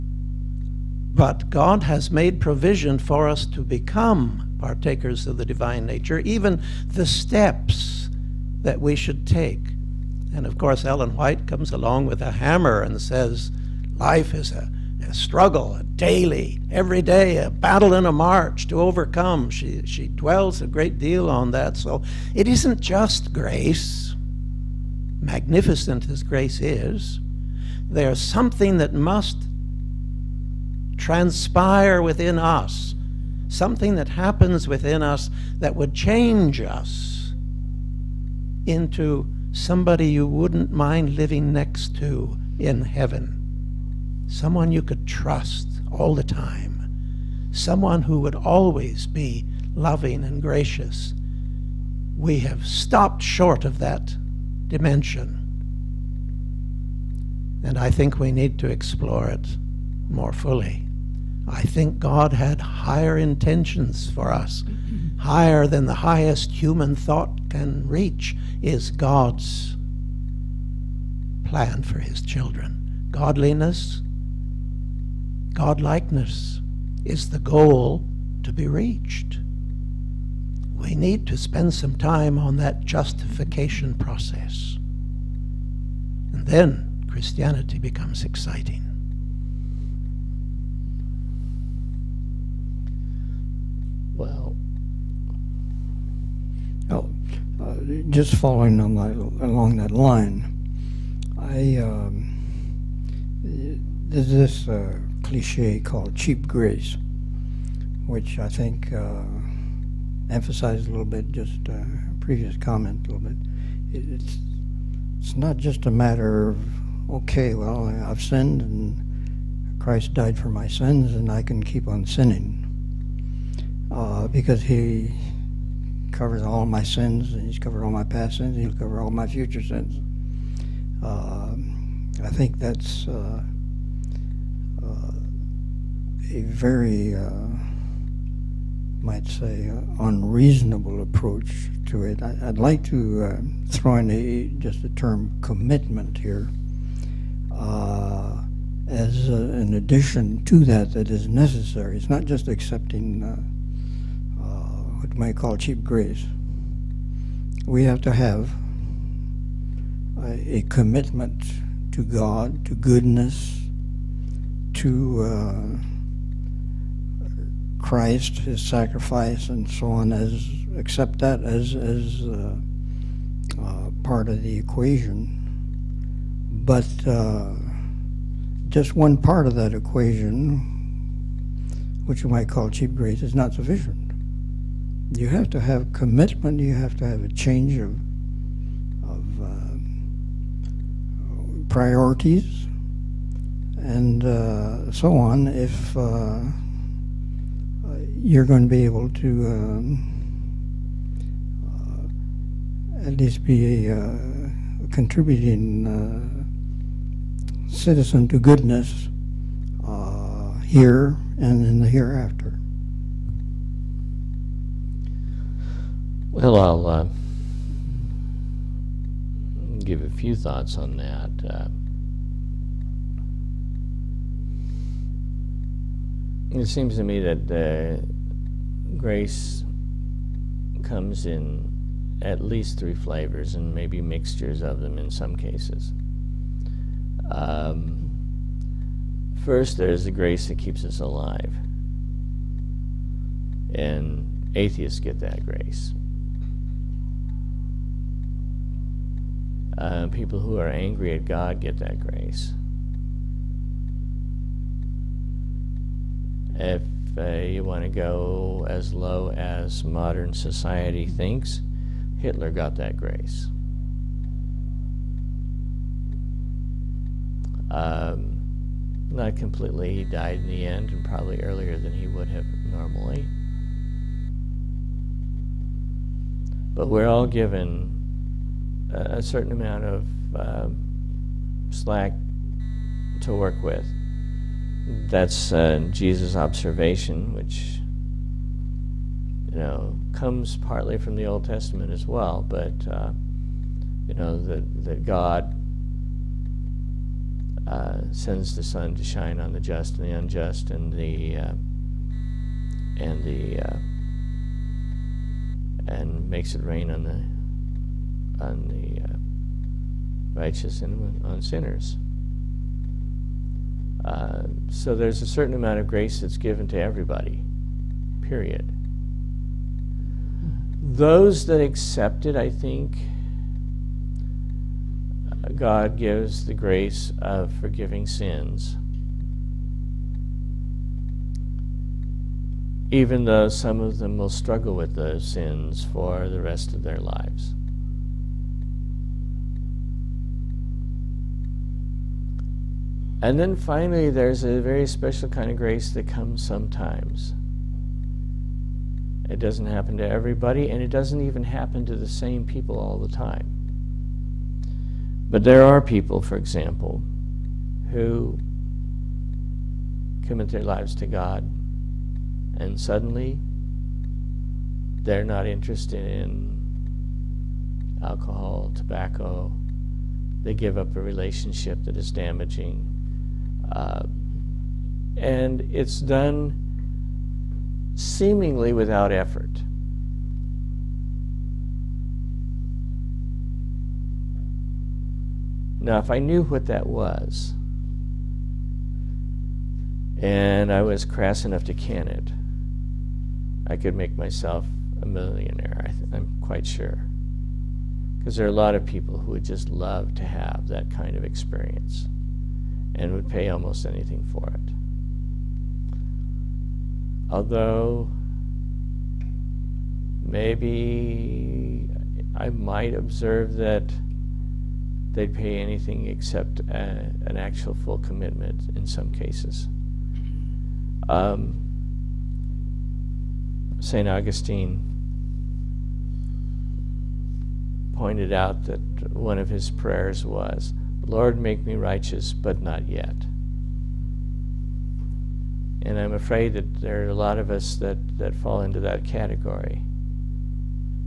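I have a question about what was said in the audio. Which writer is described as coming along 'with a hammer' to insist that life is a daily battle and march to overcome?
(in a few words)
Ellen White.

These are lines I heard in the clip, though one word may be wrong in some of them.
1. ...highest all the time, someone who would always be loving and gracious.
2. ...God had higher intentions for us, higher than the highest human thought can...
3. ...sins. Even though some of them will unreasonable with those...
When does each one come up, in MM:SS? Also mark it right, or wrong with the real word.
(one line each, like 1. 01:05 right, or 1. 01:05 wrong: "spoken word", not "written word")
1. 00:45 wrong: "trust", not "highest"
2. 01:01 right
3. 05:28 wrong: "struggle", not "unreasonable".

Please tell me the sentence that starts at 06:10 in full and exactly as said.
They give up a relationship that is damaging.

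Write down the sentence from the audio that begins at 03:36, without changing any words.
Well, I'll uh, give a few thoughts on that.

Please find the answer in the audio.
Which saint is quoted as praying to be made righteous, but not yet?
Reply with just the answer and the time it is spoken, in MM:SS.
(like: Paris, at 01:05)
St. Augustine, at 07:03.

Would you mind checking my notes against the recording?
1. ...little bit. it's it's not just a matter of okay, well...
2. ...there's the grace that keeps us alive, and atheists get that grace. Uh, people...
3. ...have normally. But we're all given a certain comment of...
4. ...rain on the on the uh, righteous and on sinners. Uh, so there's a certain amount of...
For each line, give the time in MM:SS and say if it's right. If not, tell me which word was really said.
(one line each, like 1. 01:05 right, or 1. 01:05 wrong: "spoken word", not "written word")
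1. 01:53 right
2. 03:59 right
3. 04:32 wrong: "amount", not "comment"
4. 05:06 right.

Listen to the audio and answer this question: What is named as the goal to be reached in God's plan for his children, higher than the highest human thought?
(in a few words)
Godliness, Godlikeness.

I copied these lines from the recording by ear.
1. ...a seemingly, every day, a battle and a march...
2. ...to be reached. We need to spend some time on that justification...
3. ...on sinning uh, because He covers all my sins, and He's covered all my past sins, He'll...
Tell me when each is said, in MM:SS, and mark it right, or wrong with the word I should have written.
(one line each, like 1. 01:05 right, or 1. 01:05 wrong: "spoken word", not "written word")
1. 00:15 wrong: "daily", not "seemingly"
2. 01:18 right
3. 02:01 right.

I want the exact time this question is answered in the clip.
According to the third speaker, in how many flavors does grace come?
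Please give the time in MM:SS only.
03:52.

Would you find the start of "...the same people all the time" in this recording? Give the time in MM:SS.
05:51.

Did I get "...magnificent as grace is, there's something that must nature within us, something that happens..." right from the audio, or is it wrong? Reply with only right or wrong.
wrong.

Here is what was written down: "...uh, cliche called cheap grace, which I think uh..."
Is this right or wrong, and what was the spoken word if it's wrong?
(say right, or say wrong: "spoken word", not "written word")
right.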